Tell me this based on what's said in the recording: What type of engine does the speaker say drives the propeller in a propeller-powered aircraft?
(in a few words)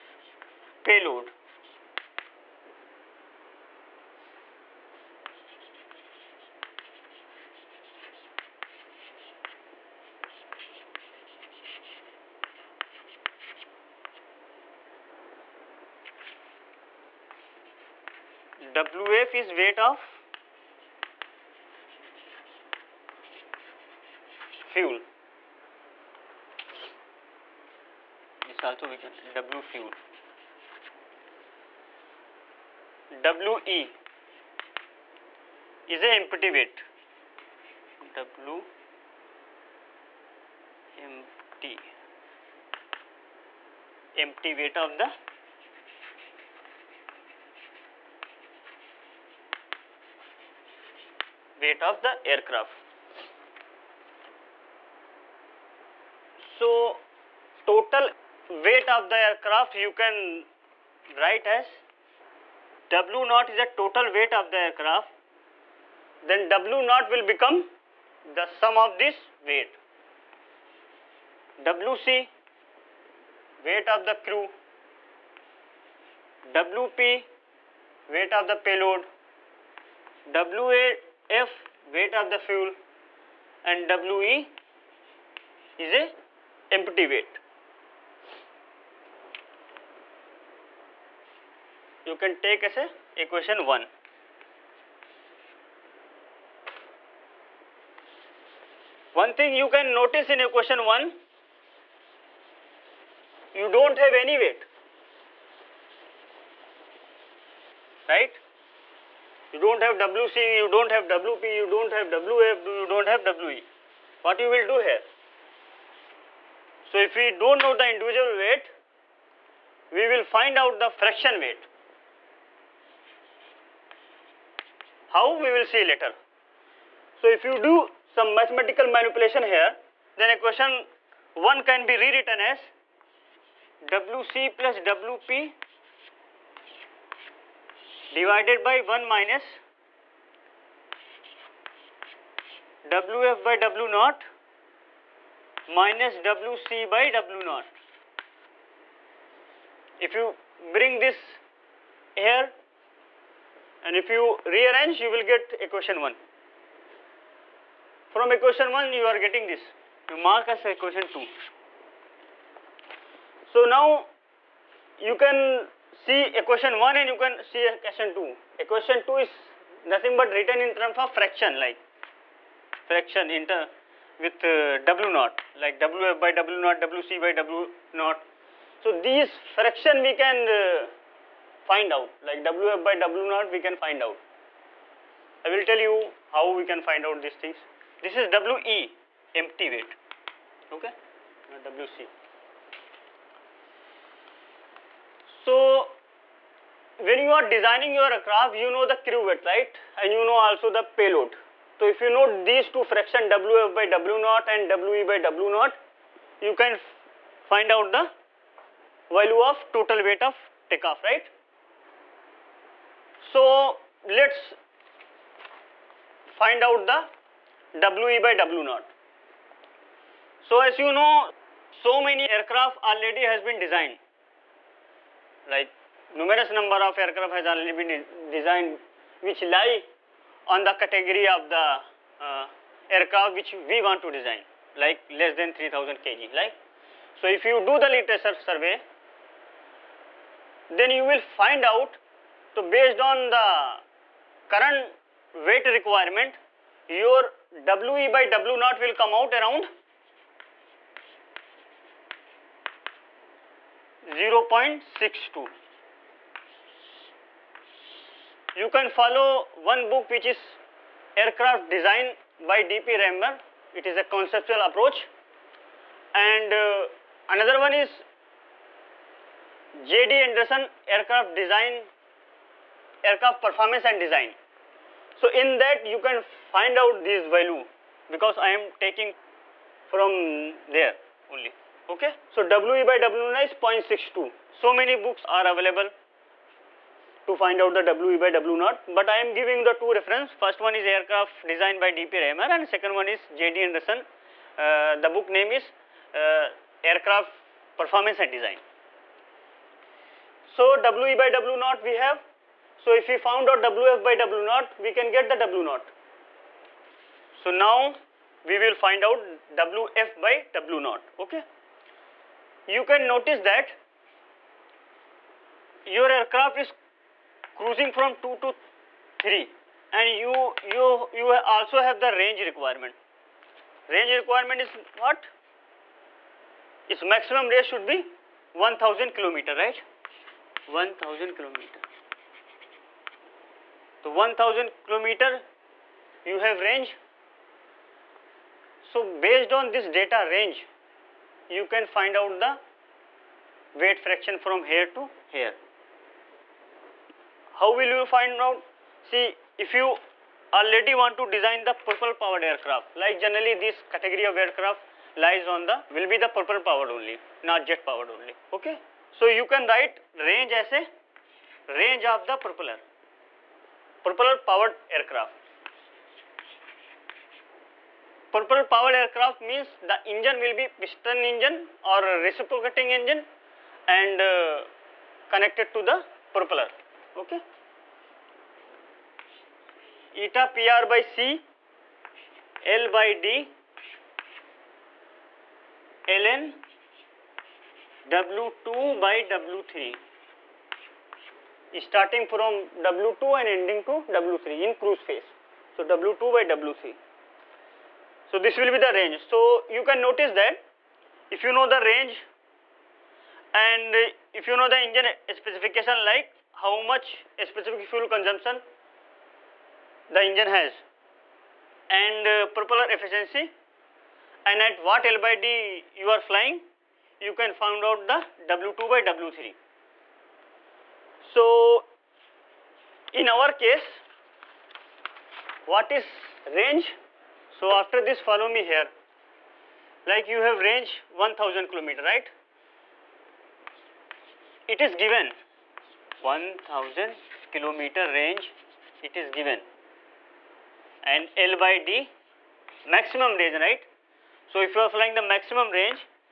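piston engine.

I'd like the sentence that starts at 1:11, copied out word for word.
WC, weight of the crew, WP, weight of the payload, WA, F weight of the fuel and WE is a empty weight.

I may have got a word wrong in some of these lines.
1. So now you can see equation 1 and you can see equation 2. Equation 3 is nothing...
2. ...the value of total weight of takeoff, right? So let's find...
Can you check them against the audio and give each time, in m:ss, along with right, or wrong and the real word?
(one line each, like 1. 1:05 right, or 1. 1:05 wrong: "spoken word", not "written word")
1. 2:43 wrong: "2", not "3"
2. 3:27 right.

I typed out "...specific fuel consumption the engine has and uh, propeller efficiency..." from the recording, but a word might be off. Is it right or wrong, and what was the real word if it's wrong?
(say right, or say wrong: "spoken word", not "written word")
right.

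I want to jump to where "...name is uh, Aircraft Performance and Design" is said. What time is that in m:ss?
4:55.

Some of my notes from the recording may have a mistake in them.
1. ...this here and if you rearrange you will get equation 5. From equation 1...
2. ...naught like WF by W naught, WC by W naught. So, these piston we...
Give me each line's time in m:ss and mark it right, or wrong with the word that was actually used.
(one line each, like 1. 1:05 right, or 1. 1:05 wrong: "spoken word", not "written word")
1. 2:30 wrong: "1", not "5"
2. 2:55 wrong: "fraction", not "piston".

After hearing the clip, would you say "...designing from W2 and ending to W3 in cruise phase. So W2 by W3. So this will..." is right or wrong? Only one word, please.
wrong.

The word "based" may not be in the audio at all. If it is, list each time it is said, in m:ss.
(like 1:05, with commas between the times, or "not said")
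4:02, 5:39.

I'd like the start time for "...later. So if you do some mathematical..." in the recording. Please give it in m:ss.
2:05.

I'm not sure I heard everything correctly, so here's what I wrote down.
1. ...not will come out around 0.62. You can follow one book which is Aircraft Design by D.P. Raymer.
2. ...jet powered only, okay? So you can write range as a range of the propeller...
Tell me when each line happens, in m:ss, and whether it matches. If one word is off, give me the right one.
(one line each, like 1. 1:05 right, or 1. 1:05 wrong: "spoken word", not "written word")
1. 4:08 right
2. 5:57 right.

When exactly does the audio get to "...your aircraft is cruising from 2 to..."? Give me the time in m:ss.
5:15.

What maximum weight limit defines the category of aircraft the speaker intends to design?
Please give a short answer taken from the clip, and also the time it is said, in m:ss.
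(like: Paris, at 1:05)
3000 kg, at 3:55.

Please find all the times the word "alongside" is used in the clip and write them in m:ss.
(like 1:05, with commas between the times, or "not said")
not said.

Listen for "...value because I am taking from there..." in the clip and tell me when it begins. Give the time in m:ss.
4:37.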